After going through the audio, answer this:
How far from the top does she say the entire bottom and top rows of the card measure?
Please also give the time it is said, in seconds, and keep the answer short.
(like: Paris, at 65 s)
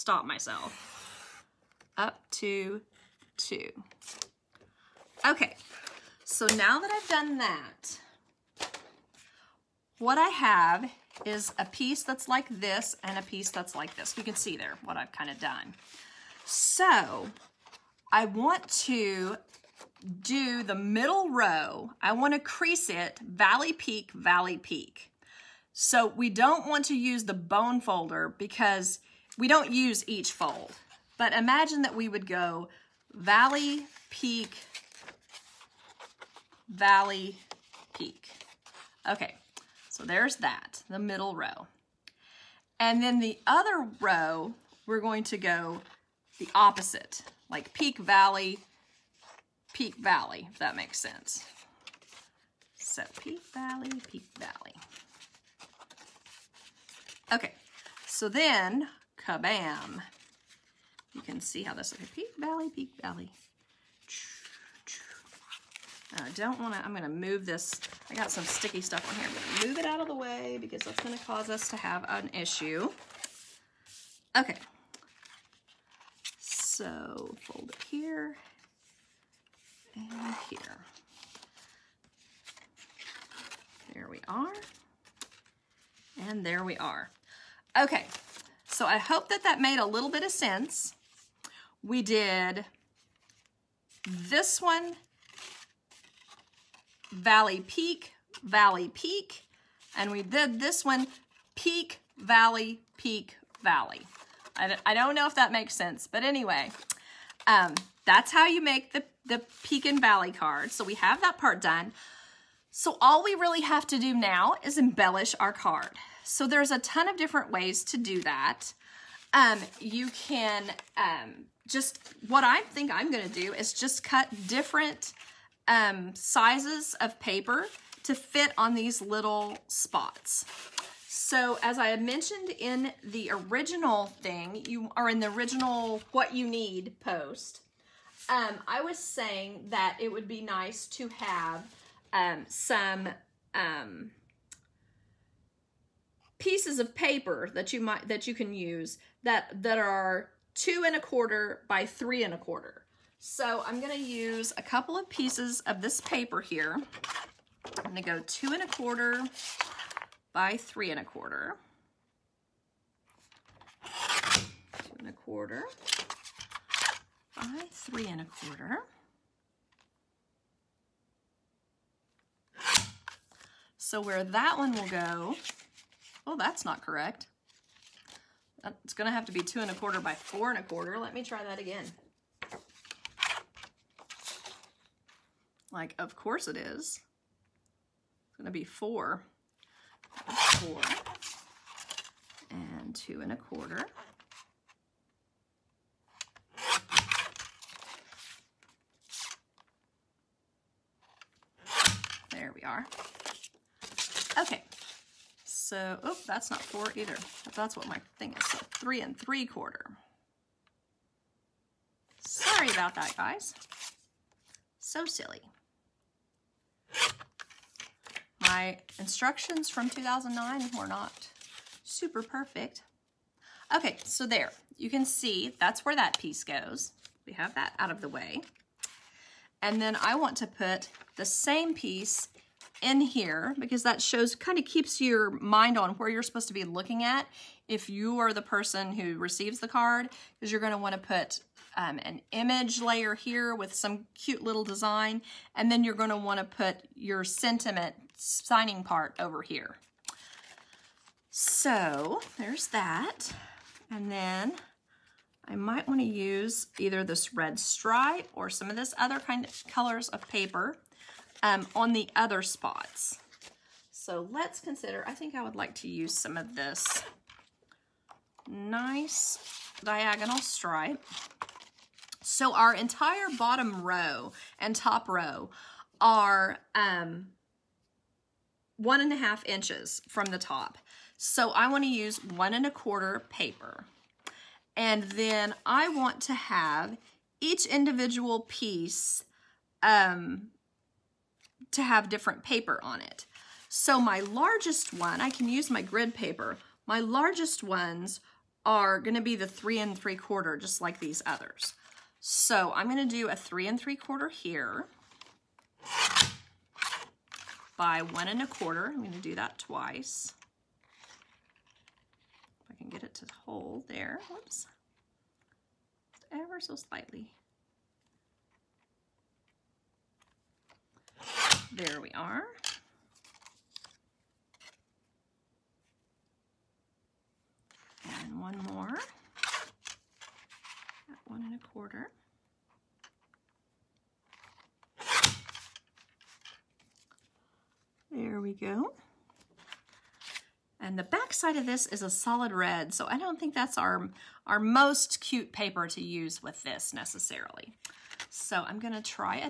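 1 and a half inches, at 278 s.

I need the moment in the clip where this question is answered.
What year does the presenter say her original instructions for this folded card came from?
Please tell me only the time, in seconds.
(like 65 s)
219 s.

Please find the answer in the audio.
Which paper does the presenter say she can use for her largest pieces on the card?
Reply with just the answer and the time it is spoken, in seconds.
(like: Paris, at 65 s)
grid paper, at 295 s.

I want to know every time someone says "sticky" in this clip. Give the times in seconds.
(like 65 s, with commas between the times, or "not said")
68 s.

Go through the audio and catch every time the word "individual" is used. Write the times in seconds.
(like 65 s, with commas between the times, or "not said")
287 s.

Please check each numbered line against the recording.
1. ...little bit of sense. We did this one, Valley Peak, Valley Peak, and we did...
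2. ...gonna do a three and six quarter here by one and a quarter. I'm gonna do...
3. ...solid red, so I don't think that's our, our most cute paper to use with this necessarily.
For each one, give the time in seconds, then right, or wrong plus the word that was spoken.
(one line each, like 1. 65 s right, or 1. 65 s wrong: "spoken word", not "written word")
1. 89 s right
2. 302 s wrong: "three", not "six"
3. 342 s right.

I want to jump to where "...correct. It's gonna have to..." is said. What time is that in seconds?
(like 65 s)
176 s.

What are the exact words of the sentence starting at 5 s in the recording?
Okay, so now that I've done that, what I have is a piece that's like this and a piece that's like this.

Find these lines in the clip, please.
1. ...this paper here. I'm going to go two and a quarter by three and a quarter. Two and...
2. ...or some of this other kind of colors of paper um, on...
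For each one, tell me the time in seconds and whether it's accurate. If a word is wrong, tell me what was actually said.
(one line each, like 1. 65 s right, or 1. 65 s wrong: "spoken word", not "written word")
1. 155 s right
2. 258 s right.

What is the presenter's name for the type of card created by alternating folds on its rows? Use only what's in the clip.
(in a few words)
peak and valley card.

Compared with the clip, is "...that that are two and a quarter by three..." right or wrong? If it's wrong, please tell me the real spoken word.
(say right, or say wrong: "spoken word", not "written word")
right.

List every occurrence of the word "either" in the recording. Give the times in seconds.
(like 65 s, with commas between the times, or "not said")
206 s, 256 s.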